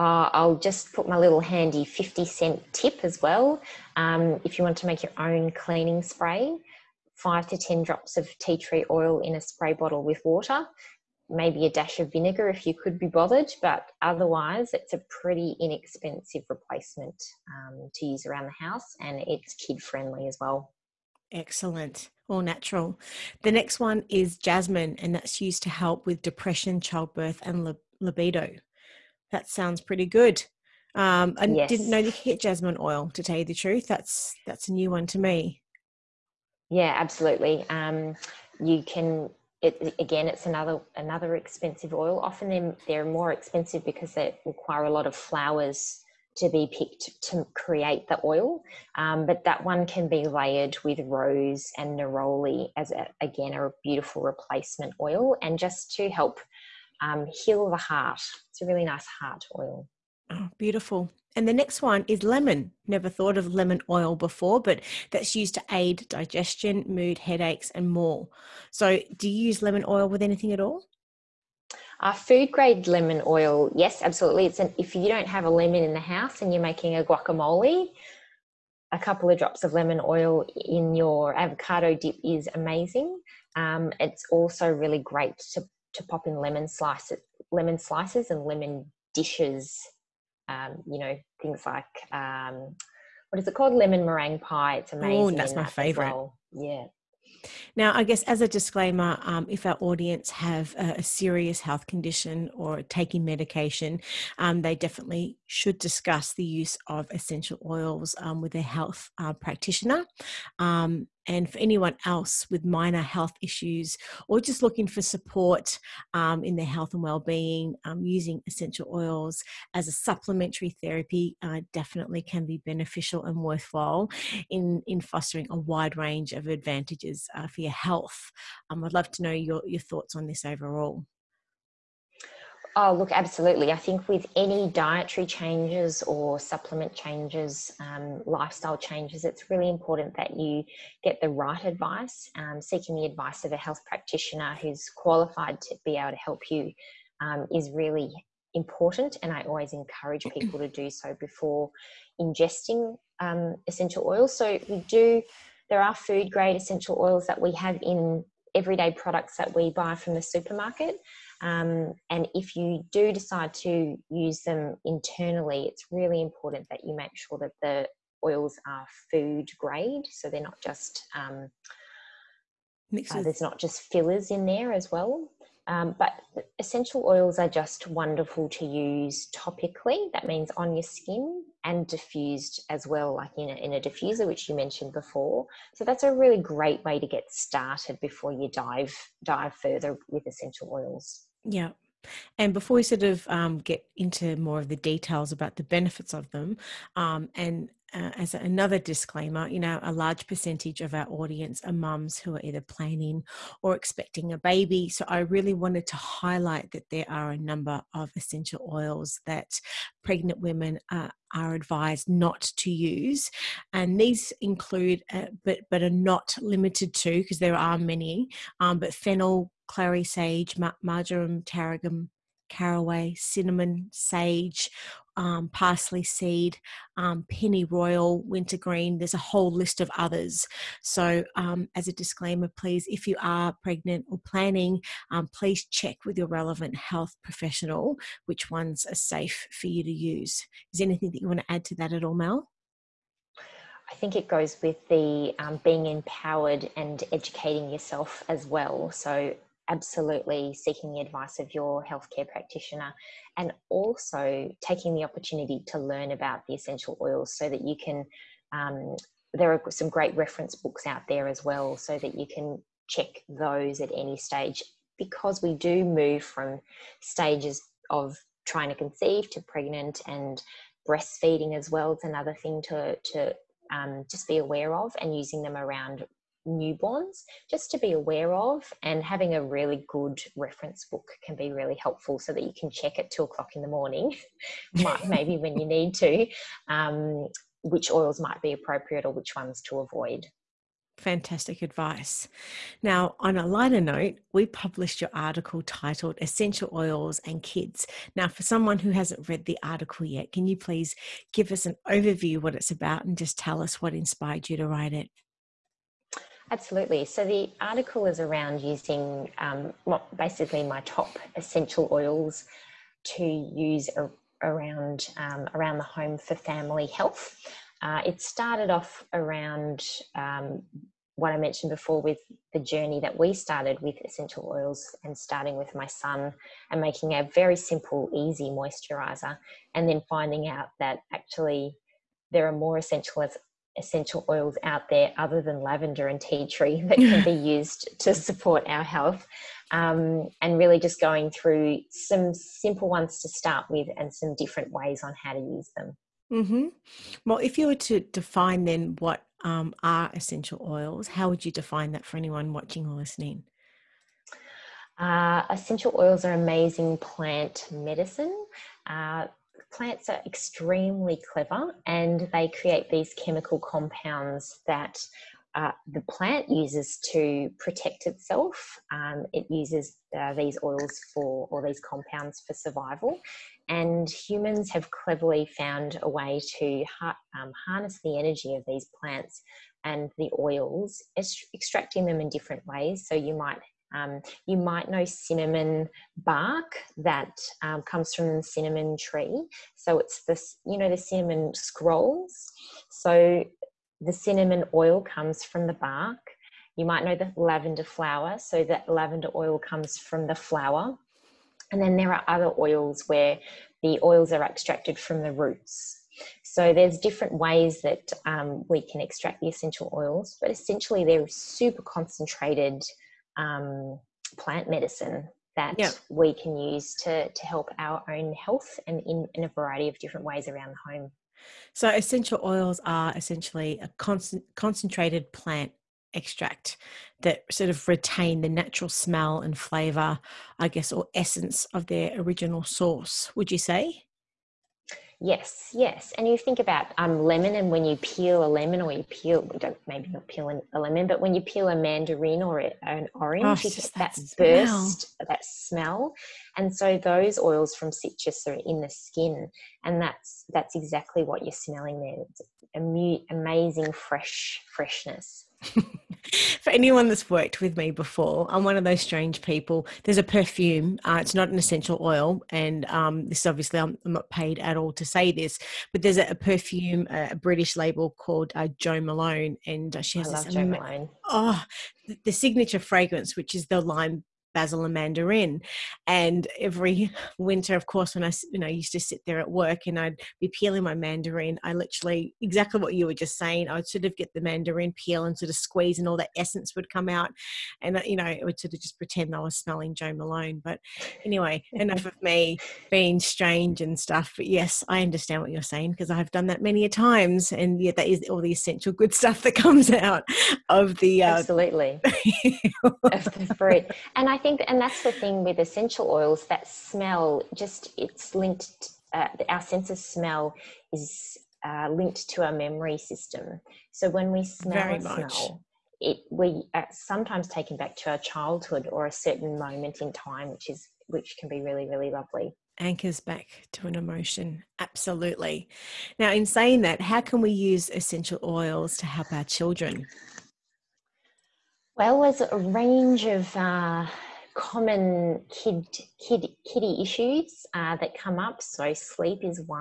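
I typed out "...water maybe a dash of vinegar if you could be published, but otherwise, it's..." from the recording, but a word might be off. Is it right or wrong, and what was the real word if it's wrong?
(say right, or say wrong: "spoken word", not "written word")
wrong: "bothered", not "published".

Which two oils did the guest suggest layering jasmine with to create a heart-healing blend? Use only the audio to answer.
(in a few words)
rose and neroli.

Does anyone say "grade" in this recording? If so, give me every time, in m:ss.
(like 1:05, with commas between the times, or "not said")
1:12, 2:36, 2:49.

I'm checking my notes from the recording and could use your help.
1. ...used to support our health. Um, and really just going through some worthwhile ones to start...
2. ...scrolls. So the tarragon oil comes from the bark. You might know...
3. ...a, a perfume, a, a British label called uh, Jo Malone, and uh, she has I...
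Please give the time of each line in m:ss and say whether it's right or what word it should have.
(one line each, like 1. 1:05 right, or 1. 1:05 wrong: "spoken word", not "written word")
1. 5:37 wrong: "simple", not "worthwhile"
2. 6:31 wrong: "cinnamon", not "tarragon"
3. 7:46 right.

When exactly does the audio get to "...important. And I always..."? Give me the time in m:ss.
2:28.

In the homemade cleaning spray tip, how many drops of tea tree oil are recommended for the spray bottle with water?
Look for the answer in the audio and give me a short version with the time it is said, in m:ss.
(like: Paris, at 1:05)
5 to 10, at 0:07.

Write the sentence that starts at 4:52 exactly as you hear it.
Now, on a lighter note, we published your article titled Essential Oils and Kids.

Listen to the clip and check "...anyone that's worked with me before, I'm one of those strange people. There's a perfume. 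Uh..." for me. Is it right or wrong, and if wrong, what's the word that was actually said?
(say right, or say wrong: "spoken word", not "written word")
right.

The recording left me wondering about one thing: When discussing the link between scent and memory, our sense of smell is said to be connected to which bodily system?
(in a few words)
memory system.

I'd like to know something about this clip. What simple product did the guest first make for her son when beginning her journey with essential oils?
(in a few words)
moisturizer.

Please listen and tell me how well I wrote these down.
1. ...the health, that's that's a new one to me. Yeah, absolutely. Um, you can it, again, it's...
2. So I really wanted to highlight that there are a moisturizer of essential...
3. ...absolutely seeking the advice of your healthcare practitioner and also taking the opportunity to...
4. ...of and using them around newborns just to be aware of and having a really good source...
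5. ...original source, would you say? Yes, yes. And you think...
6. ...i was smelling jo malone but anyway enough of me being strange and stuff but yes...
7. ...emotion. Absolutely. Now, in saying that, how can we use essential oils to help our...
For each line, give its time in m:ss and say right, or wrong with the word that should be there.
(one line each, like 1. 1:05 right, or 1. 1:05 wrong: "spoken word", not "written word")
1. 0:33 wrong: "truth", not "health"
2. 3:24 wrong: "number", not "moisturizer"
3. 4:09 right
4. 4:34 wrong: "reference", not "source"
5. 7:12 right
6. 8:09 right
7. 8:43 right.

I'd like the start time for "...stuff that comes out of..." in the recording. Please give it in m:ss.
8:19.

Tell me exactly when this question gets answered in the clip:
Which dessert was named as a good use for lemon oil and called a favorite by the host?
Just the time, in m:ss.
1:33.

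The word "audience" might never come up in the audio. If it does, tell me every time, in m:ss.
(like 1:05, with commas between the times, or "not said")
1:39, 3:21.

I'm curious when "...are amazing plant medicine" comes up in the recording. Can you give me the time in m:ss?
5:56.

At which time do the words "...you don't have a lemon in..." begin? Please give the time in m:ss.
1:14.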